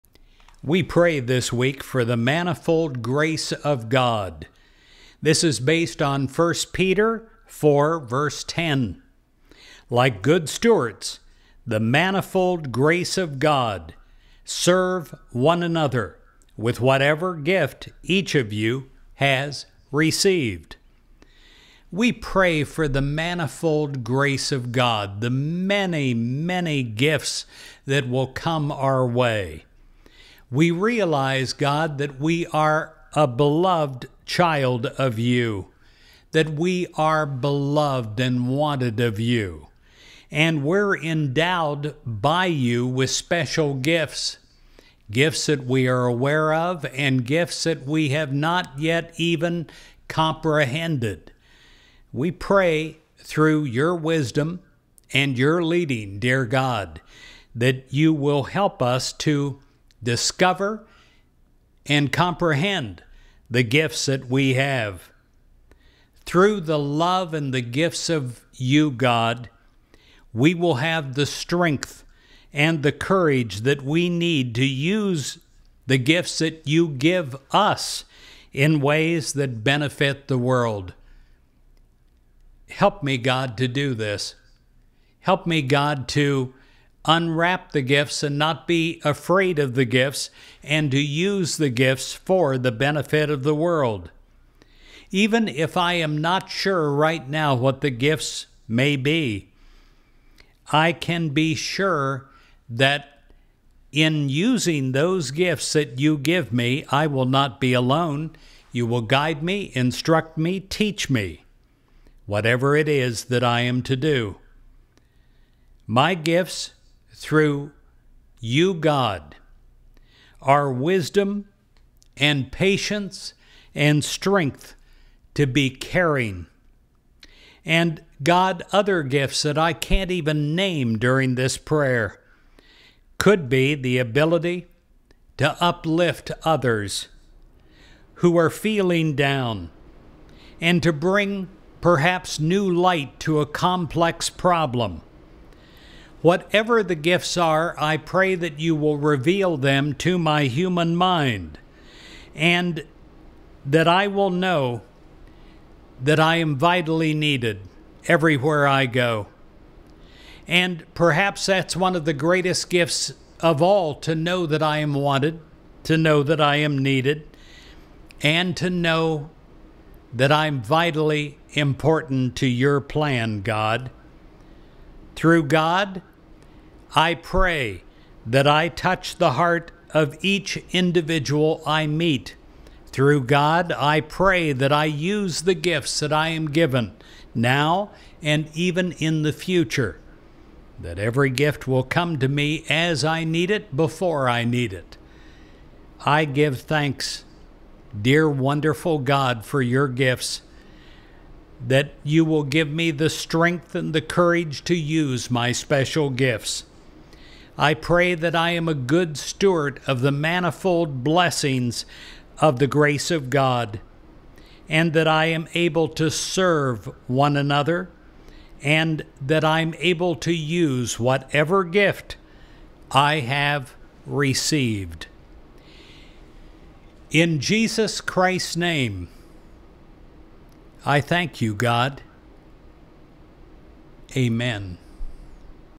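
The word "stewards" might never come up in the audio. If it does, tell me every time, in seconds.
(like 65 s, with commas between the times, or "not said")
10 s, 209 s.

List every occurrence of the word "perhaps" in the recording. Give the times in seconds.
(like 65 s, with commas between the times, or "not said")
141 s, 160 s.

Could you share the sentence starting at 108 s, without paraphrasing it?
You will guide me, instruct me, teach me, whatever it is that I am to do.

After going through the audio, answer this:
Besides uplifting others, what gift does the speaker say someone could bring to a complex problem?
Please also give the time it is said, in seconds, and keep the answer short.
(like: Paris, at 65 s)
New light, at 142 s.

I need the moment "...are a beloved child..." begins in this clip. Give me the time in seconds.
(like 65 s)
32 s.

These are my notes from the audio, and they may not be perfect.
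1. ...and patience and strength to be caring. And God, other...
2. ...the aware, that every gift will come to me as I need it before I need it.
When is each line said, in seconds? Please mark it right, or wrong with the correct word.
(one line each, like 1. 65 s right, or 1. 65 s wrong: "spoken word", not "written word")
1. 122 s right
2. 189 s wrong: "future", not "aware".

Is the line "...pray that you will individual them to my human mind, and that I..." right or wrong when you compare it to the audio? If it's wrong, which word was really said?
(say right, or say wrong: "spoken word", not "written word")
wrong: "reveal", not "individual".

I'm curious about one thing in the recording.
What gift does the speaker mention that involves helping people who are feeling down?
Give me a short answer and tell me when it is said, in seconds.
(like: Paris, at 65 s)
Ability to uplift others, at 133 s.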